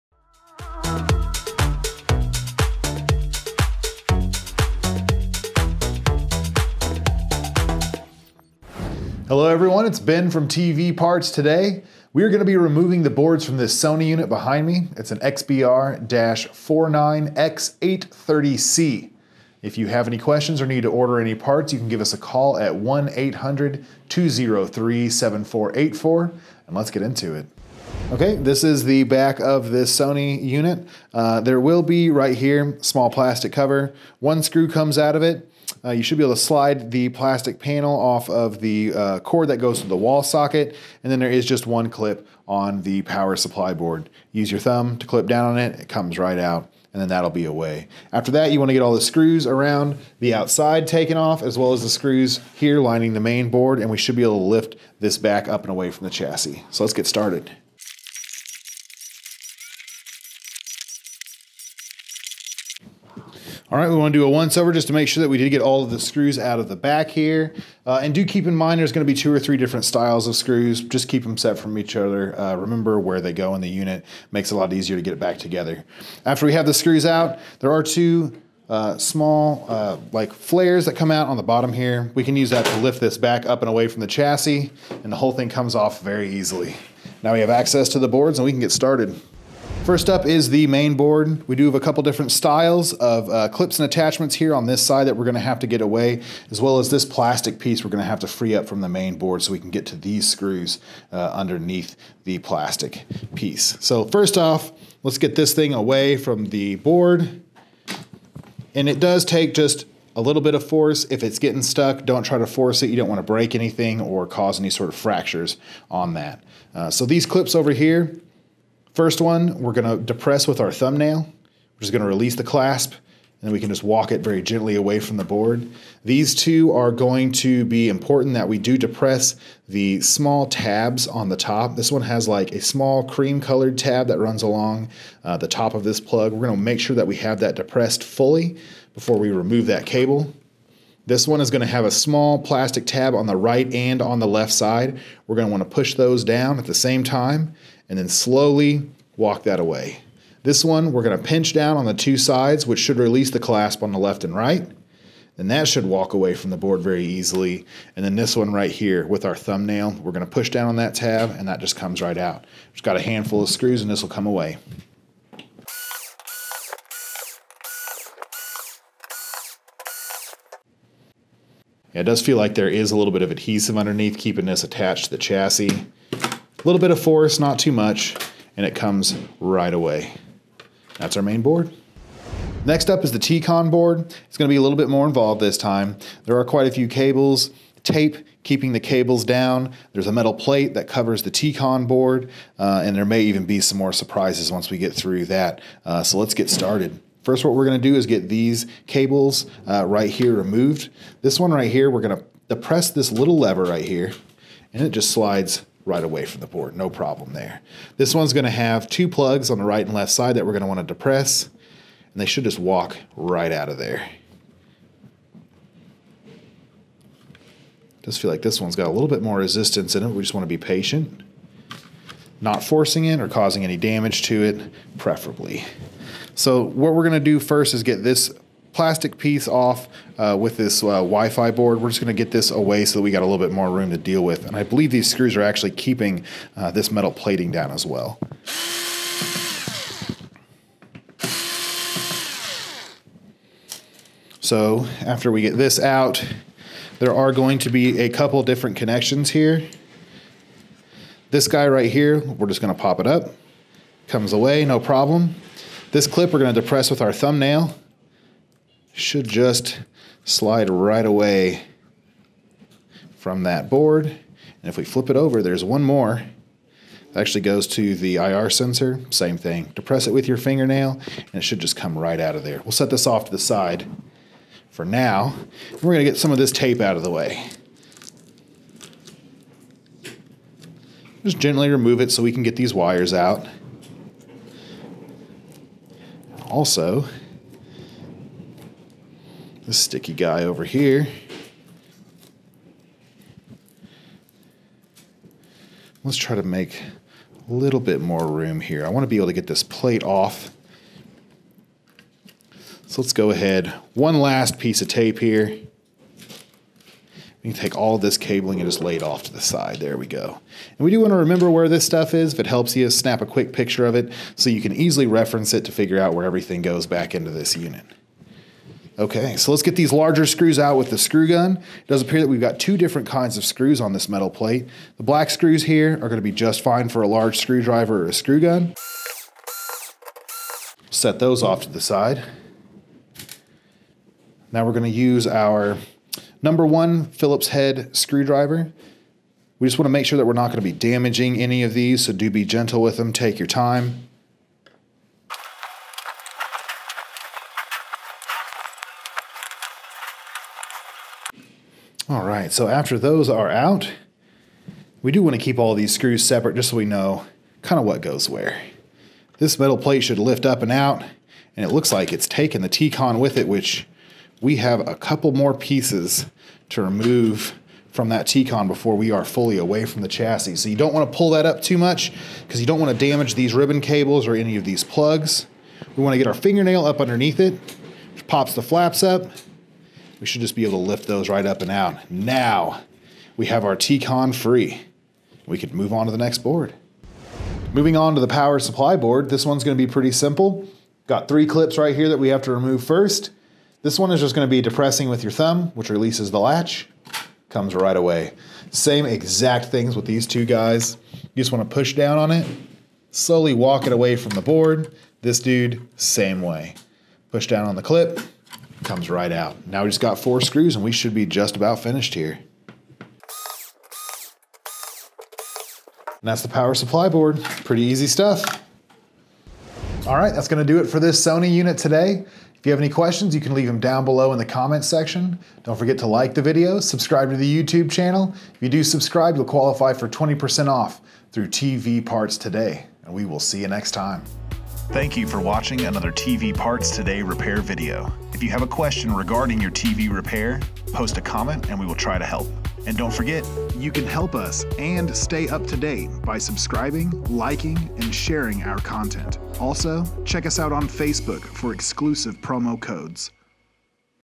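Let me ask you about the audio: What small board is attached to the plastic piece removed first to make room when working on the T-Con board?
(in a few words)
Wi-Fi board.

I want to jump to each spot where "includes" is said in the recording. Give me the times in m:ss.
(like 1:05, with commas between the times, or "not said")
not said.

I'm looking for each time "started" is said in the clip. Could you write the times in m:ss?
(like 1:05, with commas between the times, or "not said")
0:57, 1:28, 3:16.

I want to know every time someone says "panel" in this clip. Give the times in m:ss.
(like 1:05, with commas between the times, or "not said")
0:37.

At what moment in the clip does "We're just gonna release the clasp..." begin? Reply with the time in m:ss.
2:01.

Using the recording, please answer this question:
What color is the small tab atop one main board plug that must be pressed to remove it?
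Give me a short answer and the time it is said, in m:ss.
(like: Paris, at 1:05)
Cream, at 2:13.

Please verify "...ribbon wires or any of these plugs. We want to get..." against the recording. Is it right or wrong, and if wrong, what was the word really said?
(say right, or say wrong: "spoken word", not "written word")
wrong: "cables", not "wires".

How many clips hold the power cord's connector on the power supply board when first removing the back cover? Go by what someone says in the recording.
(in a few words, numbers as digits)
1.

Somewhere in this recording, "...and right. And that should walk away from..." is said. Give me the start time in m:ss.
2:34.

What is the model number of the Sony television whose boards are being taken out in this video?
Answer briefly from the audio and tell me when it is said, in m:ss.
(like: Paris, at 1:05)
XBR-49X830C, at 0:15.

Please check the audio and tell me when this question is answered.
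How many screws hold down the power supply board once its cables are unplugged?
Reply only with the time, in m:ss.
6:50.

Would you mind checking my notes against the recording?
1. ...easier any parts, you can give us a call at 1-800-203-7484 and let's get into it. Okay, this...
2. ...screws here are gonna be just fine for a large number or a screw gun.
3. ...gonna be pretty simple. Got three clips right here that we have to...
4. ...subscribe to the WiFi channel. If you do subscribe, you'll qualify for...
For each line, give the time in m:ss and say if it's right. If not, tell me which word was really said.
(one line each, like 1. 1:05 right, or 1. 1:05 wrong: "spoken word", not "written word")
1. 0:20 wrong: "order", not "easier"
2. 5:25 wrong: "screwdriver", not "number"
3. 6:29 right
4. 7:06 wrong: "YouTube", not "WiFi".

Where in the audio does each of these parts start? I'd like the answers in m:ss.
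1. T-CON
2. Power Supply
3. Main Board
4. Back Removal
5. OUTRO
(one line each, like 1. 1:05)
1. 3:02
2. 6:27
3. 1:29
4. 0:28
5. 7:00.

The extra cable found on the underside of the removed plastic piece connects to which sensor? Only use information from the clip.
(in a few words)
IR sensor.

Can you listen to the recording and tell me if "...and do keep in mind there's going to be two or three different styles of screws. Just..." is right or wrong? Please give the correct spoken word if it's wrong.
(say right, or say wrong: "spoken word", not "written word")
right.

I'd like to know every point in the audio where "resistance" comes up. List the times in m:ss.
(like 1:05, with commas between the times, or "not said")
3:39.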